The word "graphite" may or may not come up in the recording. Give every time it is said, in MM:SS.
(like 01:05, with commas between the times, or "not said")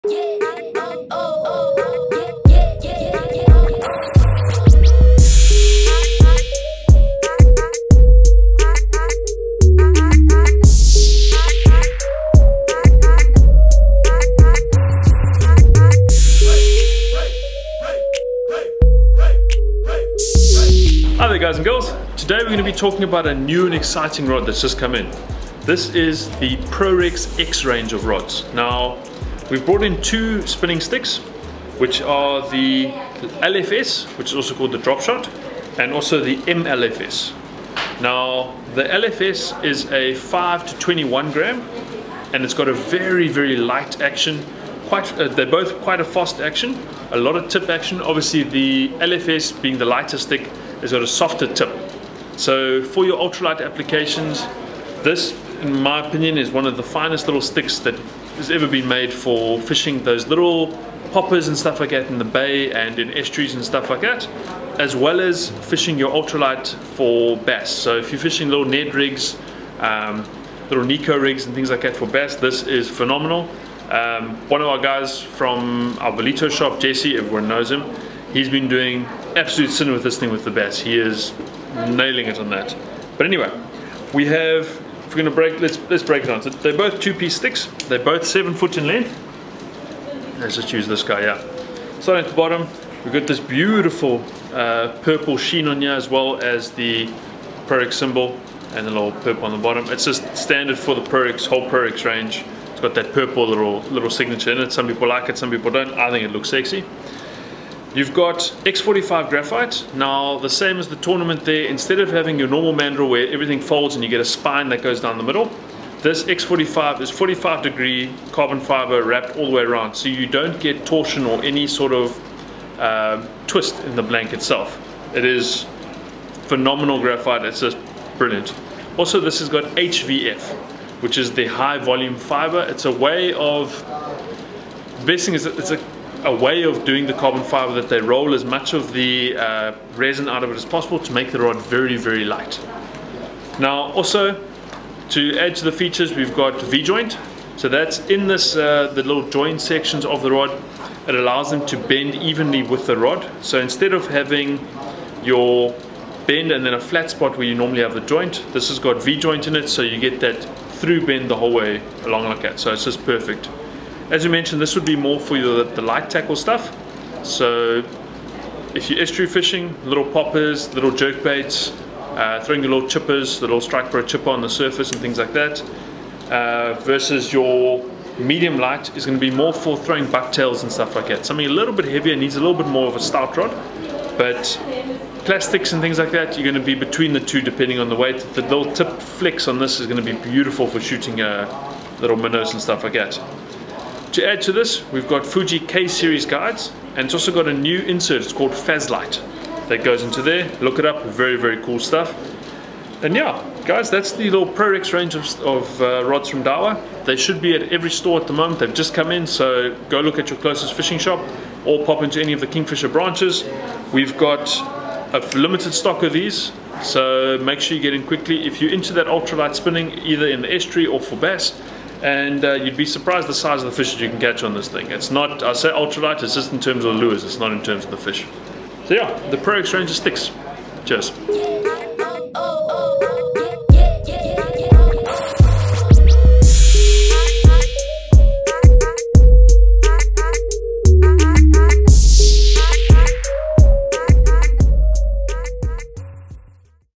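01:49, 02:07.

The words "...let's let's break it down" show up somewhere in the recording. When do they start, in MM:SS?
01:25.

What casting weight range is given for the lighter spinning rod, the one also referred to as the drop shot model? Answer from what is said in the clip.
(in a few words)
5 to 21 grams.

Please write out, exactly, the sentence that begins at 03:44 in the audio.
It's not, I say ultralight, it's just in terms of the lures, it's not in terms of the fish.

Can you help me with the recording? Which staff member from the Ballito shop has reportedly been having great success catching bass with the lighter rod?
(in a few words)
Jesse.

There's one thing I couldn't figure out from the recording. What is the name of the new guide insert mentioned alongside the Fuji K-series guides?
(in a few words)
Fazlite.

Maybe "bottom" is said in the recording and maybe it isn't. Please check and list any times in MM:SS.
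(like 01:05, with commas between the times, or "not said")
01:32, 01:39.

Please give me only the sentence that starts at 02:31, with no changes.
It allows them to bend evenly with the rod.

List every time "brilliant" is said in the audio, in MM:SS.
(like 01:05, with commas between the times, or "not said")
02:08.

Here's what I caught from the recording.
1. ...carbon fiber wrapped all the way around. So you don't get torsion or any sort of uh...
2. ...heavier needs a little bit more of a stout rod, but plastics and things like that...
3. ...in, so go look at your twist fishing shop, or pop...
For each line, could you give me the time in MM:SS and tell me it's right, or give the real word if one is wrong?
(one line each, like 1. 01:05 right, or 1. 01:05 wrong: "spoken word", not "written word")
1. 01:58 right
2. 03:01 right
3. 03:29 wrong: "closest", not "twist".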